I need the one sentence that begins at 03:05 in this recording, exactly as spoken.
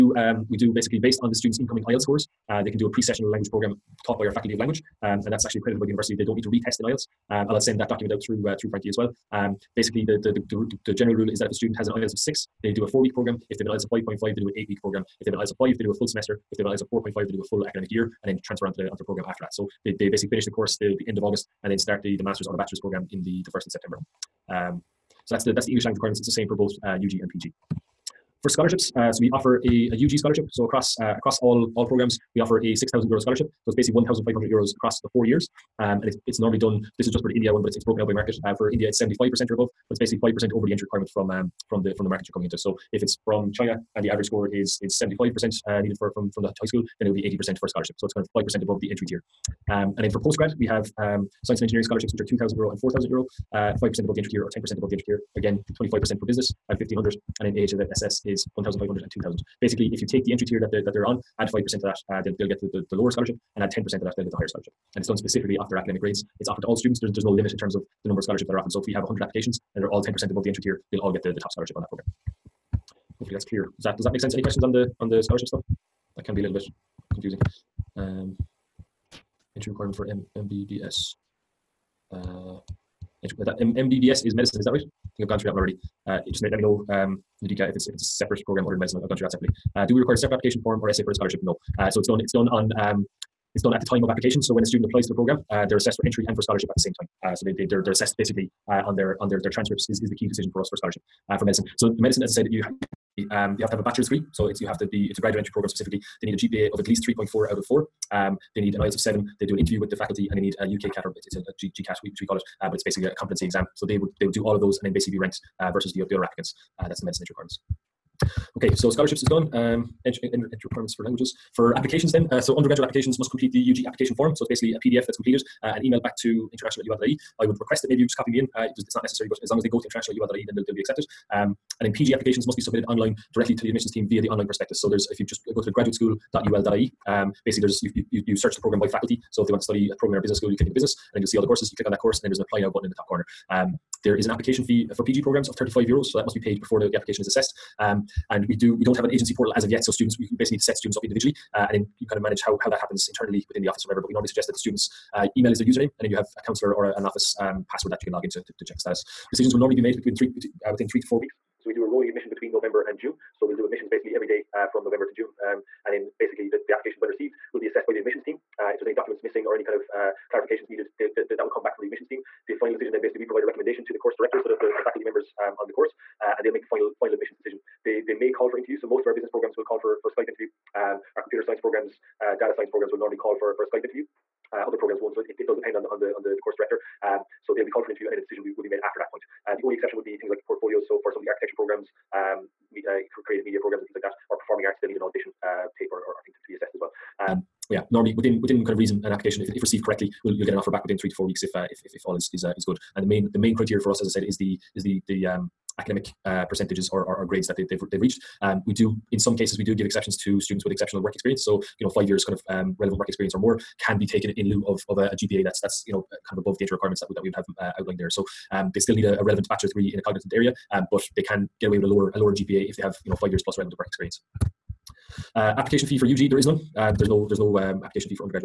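So it, it, it, does depend on the on the on the, the course director.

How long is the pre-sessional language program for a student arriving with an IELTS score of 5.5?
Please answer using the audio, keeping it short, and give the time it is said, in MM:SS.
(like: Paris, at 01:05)
8 weeks, at 00:14.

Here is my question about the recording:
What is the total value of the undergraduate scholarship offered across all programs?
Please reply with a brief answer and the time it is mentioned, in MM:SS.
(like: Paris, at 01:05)
6,000 euro, at 00:32.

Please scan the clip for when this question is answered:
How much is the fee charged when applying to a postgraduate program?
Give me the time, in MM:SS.
02:25.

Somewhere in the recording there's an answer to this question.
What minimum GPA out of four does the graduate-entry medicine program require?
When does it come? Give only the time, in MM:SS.
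01:47.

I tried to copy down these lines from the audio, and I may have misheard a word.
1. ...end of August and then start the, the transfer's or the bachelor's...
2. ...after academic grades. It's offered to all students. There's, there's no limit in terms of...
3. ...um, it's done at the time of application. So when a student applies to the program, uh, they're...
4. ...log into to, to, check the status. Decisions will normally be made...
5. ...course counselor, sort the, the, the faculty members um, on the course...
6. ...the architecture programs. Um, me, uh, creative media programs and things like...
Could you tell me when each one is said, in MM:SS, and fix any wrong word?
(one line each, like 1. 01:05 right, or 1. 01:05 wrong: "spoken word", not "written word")
1. 00:21 wrong: "master", not "transfer"
2. 01:05 right
3. 01:32 right
4. 02:38 right
5. 02:53 wrong: "director", not "counselor"
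6. 03:11 right.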